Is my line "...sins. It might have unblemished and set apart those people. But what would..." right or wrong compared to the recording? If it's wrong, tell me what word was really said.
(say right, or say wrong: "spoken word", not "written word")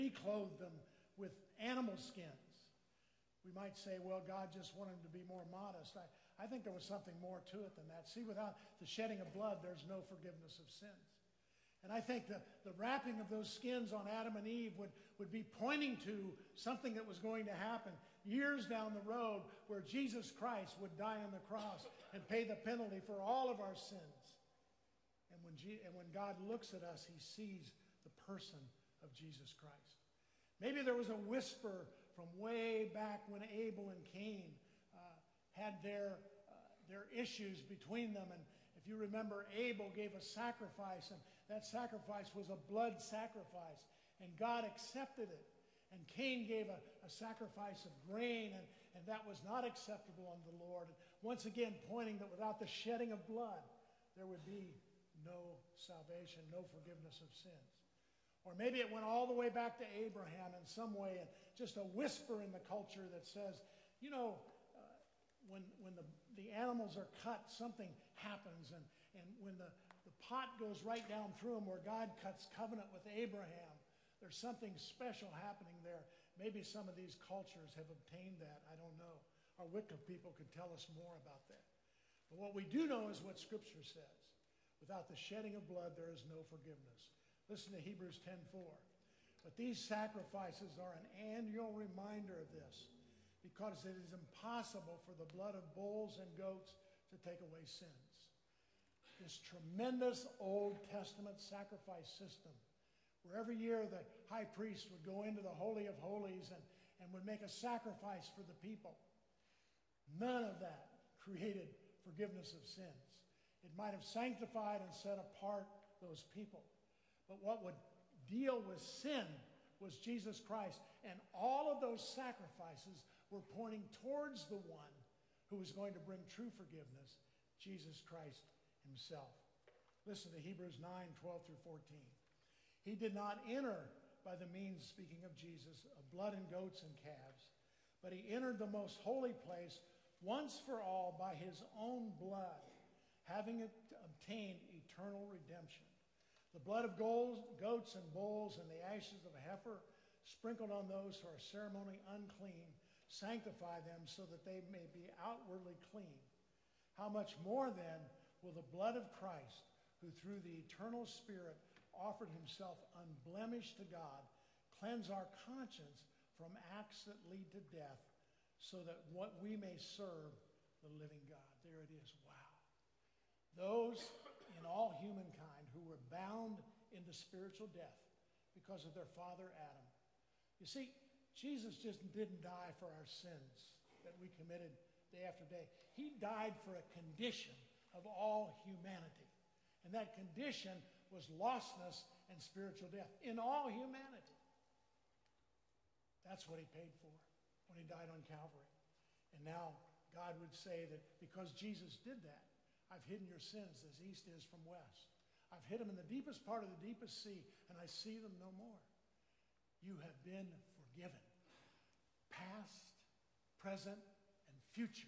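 wrong: "sanctified", not "unblemished".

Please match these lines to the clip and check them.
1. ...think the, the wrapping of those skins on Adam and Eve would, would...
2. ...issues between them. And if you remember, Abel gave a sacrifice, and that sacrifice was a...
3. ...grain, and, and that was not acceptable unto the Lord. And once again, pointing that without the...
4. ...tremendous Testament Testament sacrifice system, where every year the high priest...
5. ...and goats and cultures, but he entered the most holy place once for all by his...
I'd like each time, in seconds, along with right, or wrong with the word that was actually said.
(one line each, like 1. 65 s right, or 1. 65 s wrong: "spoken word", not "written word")
1. 12 s right
2. 37 s right
3. 48 s right
4. 99 s wrong: "Old", not "Testament"
5. 136 s wrong: "calves", not "cultures".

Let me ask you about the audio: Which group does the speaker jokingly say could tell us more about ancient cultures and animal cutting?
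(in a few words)
Wicca people.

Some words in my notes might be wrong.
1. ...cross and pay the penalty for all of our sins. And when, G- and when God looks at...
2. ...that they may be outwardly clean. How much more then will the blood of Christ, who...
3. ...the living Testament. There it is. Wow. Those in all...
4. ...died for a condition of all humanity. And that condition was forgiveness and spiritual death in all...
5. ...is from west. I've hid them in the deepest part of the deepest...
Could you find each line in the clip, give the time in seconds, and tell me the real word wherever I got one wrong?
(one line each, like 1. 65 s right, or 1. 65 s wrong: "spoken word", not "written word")
1. 21 s right
2. 154 s right
3. 170 s wrong: "God", not "Testament"
4. 186 s wrong: "lostness", not "forgiveness"
5. 204 s right.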